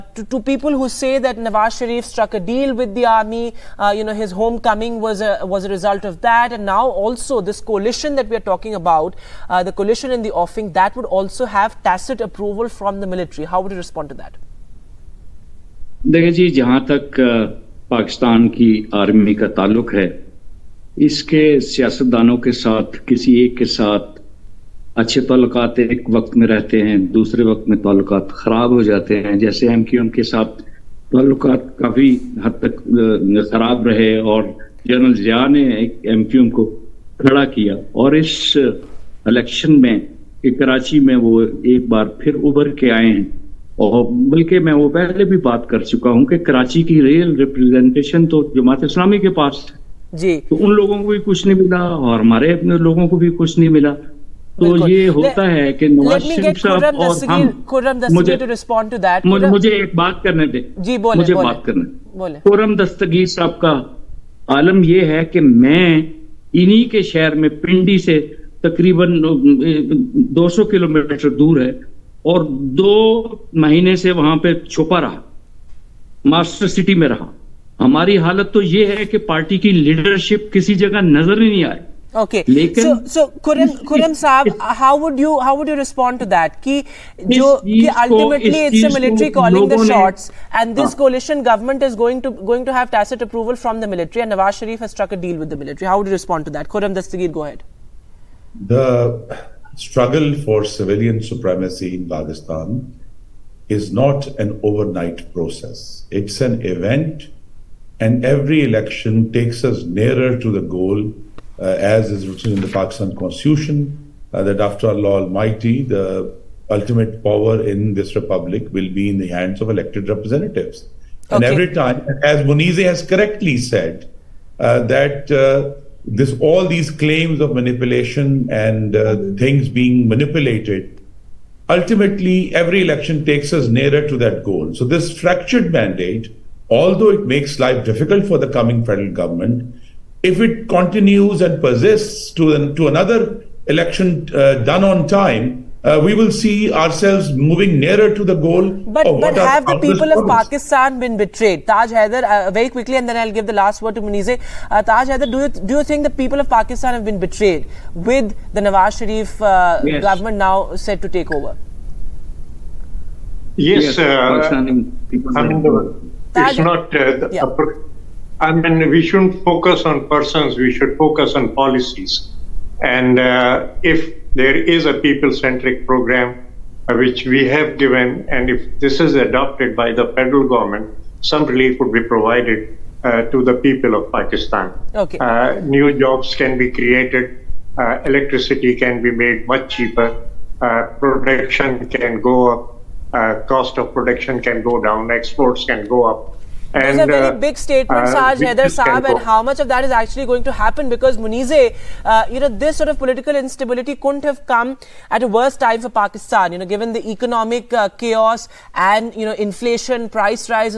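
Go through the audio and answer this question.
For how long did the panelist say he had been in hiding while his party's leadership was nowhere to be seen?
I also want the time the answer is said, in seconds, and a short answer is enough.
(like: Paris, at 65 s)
2 months, at 72 s.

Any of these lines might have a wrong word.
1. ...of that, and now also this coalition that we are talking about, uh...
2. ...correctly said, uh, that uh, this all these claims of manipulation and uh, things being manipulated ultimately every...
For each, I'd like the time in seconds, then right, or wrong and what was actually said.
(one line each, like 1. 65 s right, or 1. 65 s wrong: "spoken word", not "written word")
1. 6 s right
2. 123 s right.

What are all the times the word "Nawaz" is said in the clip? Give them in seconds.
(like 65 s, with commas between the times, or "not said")
1 s, 158 s.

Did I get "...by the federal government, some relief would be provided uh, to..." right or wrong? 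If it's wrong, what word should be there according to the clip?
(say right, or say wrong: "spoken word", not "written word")
right.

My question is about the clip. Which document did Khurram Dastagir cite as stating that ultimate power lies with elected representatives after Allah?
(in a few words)
Pakistan Constitution.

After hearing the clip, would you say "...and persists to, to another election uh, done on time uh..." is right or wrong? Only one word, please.
right.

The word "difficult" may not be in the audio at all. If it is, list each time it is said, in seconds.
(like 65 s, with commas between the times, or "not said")
137 s.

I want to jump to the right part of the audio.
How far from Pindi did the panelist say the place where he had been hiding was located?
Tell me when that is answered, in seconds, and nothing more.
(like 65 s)
70 s.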